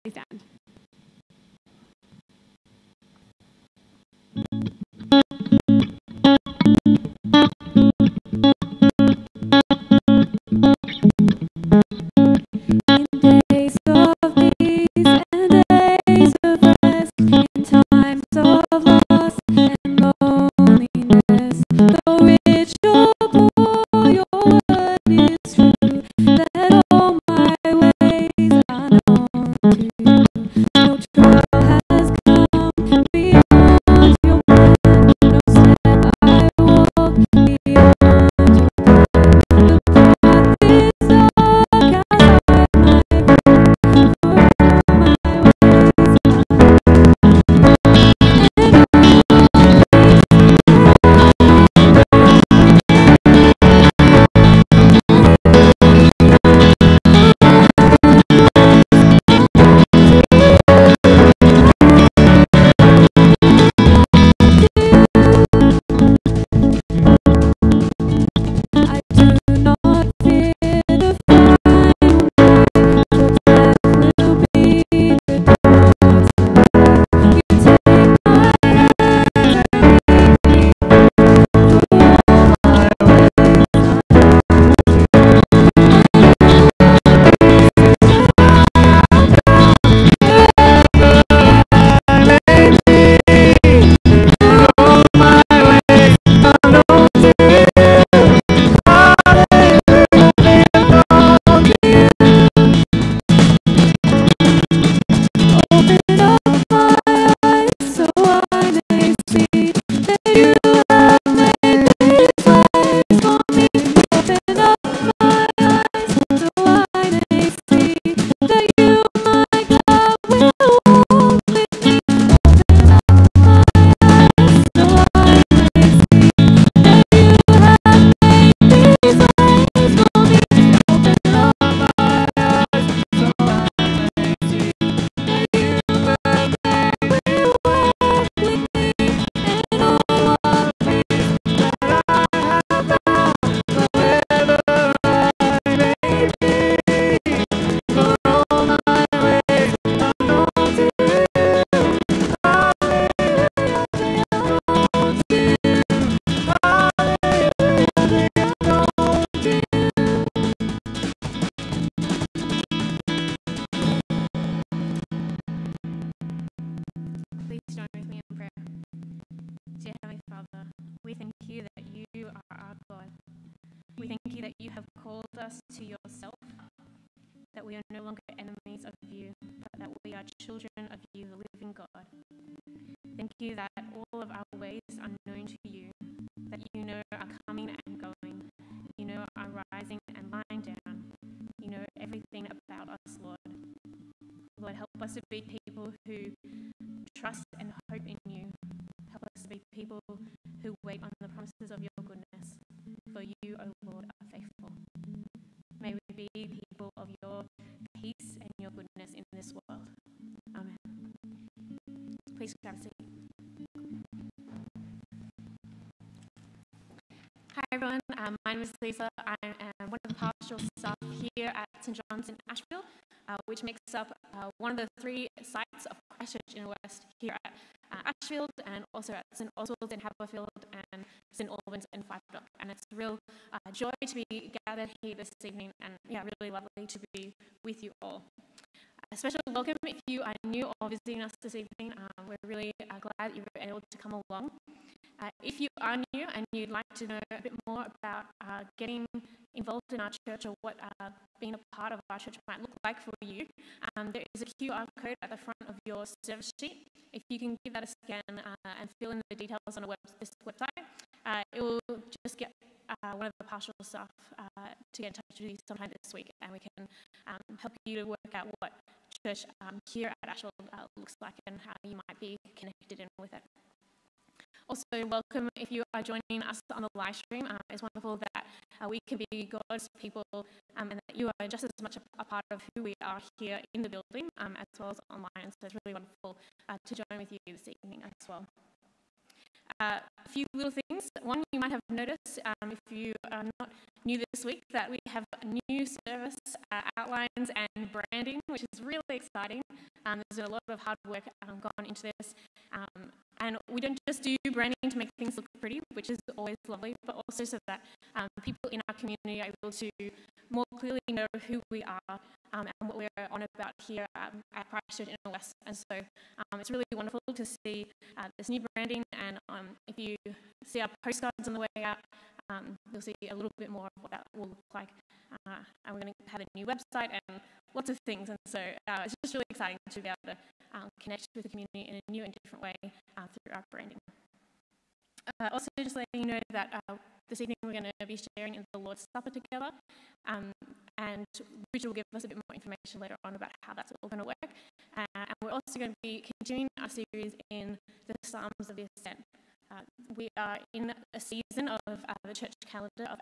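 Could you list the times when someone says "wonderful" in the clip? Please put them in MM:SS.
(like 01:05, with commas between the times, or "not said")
04:37, 04:45, 05:16.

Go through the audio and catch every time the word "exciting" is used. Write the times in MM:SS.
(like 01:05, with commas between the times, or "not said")
04:59, 05:29.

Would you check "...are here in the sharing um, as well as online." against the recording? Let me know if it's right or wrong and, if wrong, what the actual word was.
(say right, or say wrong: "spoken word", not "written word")
wrong: "building", not "sharing".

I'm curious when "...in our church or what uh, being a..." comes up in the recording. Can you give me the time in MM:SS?
04:09.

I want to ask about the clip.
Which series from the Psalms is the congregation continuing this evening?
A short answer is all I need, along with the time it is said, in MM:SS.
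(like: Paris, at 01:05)
Psalms of the Ascent, at 05:48.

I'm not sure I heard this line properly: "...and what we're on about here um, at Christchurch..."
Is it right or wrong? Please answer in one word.
right.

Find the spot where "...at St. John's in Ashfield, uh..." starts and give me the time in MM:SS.
03:41.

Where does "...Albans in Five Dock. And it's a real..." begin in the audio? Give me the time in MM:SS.
03:51.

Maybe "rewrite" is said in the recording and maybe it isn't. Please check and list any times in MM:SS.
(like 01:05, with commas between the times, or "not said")
not said.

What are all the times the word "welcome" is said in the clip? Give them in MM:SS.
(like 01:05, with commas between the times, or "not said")
03:59, 04:35.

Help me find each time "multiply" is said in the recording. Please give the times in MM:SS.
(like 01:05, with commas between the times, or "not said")
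not said.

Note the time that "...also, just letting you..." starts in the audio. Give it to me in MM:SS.
05:35.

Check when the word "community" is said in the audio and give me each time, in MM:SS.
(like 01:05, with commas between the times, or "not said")
05:08, 05:31.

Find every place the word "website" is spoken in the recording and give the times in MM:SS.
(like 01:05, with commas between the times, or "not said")
04:20, 05:26.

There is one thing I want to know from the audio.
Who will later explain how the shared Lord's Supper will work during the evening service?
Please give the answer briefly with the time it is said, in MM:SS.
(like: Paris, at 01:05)
Richard, at 05:41.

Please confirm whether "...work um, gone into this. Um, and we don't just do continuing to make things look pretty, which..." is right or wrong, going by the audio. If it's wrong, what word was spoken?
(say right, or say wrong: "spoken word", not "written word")
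wrong: "branding", not "continuing".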